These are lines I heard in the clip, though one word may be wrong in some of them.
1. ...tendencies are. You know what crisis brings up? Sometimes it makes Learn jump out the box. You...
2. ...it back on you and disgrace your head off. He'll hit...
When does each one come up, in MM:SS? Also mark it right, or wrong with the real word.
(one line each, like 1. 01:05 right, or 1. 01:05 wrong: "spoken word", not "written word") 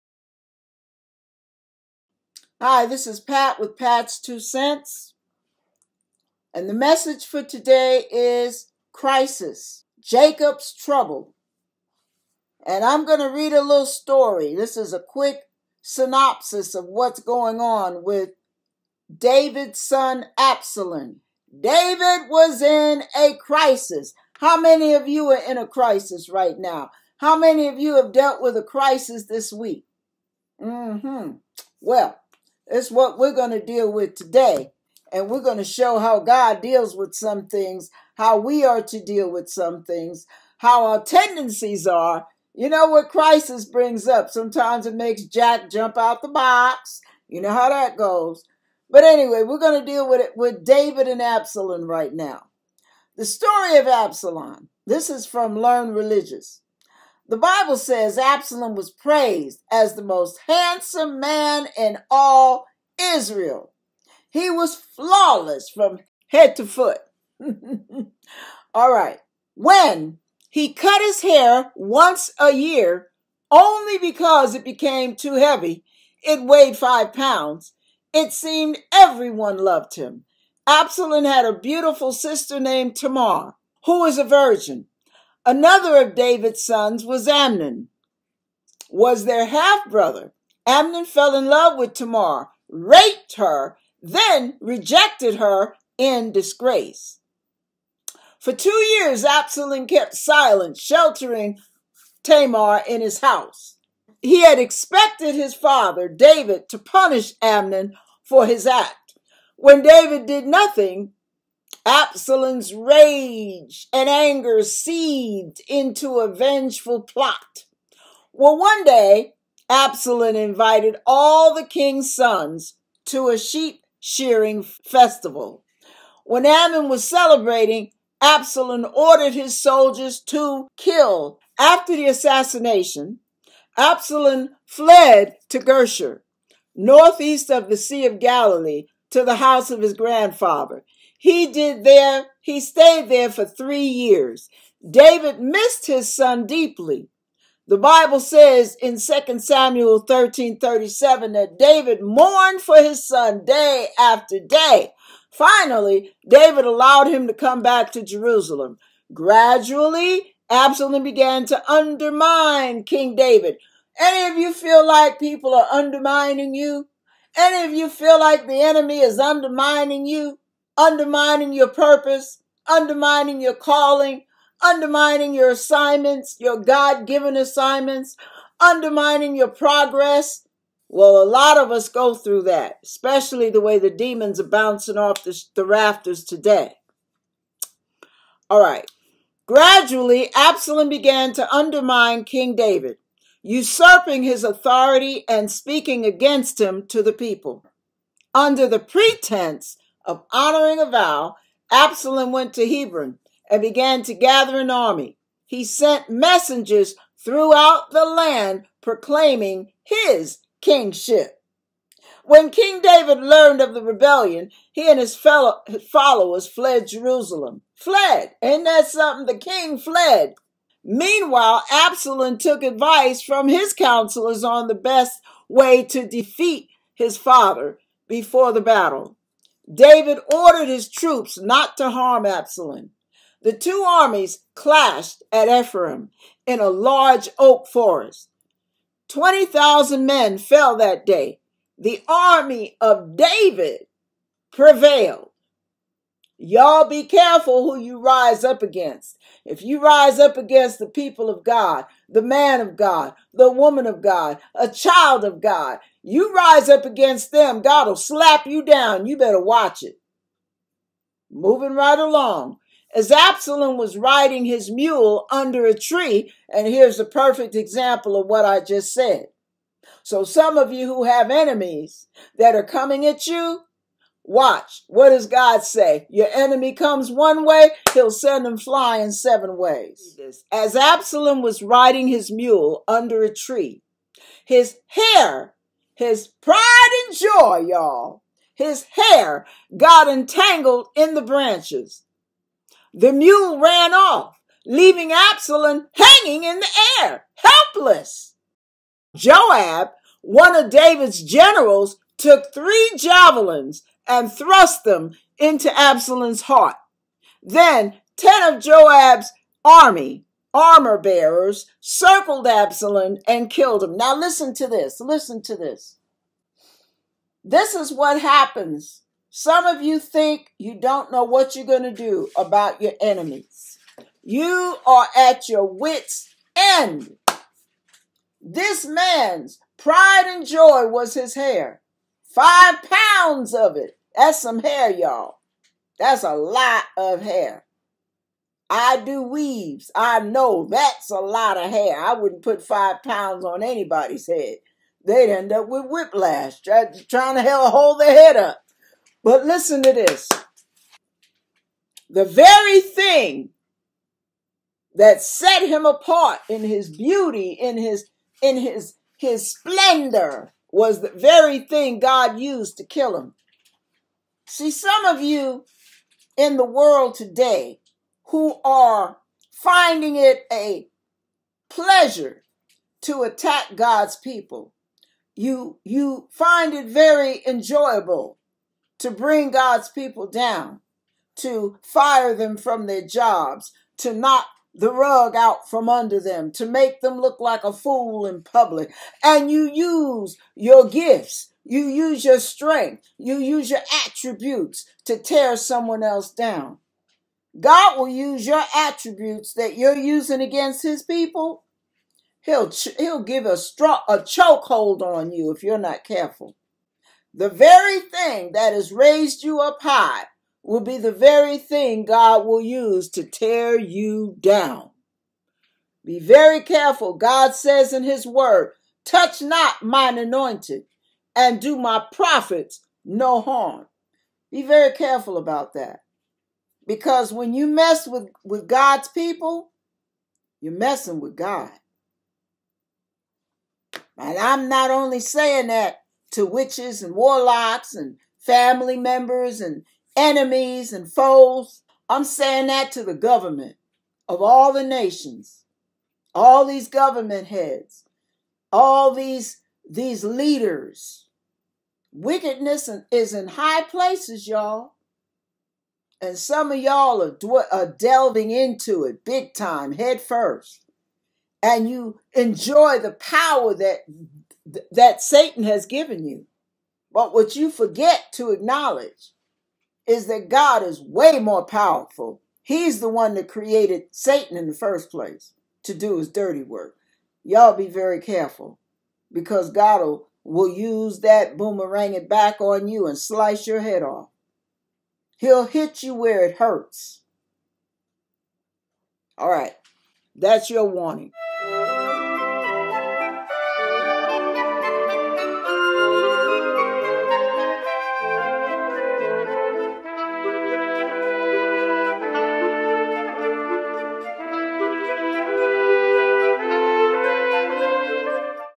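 1. 00:41 wrong: "Jack", not "Learn"
2. 08:02 wrong: "slice", not "disgrace".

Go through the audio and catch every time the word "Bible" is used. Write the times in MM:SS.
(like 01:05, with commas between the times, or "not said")
00:57, 02:27.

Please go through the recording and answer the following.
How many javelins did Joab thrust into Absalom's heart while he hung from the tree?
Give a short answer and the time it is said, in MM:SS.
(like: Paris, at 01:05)
3, at 05:02.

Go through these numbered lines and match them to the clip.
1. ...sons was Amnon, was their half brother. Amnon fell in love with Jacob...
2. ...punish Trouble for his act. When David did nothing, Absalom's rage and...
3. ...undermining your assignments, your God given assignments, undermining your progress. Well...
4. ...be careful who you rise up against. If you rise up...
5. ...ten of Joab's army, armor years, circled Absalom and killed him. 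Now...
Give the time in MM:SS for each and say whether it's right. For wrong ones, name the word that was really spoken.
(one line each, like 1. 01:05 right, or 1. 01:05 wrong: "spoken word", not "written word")
1. 01:26 wrong: "Tamar", not "Jacob"
2. 01:46 wrong: "Amnon", not "Trouble"
3. 02:54 right
4. 04:06 right
5. 05:08 wrong: "bearers", not "years".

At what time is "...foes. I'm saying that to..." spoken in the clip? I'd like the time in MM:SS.
07:21.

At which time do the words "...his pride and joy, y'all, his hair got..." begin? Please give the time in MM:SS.
04:45.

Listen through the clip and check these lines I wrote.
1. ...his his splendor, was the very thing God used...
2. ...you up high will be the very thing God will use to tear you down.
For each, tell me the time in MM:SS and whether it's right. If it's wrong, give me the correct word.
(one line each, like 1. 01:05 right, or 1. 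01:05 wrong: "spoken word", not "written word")
1. 05:58 right
2. 06:49 right.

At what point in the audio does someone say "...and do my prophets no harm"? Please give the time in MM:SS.
07:01.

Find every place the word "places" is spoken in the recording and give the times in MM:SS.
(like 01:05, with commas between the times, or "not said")
07:33, 07:55.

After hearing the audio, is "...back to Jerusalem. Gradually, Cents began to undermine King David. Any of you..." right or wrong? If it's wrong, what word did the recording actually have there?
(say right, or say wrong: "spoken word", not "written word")
wrong: "Absalom", not "Cents".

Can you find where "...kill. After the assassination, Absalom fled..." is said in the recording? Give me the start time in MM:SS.
02:10.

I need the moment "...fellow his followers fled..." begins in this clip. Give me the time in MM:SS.
03:35.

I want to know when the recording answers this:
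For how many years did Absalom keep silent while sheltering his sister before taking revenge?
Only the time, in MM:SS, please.
01:38.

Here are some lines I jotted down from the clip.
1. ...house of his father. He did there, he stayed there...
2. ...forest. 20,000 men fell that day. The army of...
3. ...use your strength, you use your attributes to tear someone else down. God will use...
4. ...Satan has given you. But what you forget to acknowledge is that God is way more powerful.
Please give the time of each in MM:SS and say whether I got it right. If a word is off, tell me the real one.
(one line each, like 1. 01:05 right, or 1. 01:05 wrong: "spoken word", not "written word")
1. 02:19 wrong: "grandfather", not "father"
2. 03:57 right
3. 06:31 right
4. 07:45 right.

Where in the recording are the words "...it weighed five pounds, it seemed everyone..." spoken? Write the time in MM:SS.
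01:16.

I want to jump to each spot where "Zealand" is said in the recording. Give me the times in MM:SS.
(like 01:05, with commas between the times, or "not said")
not said.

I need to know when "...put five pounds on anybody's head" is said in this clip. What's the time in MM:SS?
05:42.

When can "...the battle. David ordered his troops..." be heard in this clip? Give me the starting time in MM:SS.
03:48.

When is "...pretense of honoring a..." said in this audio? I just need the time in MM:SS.
03:18.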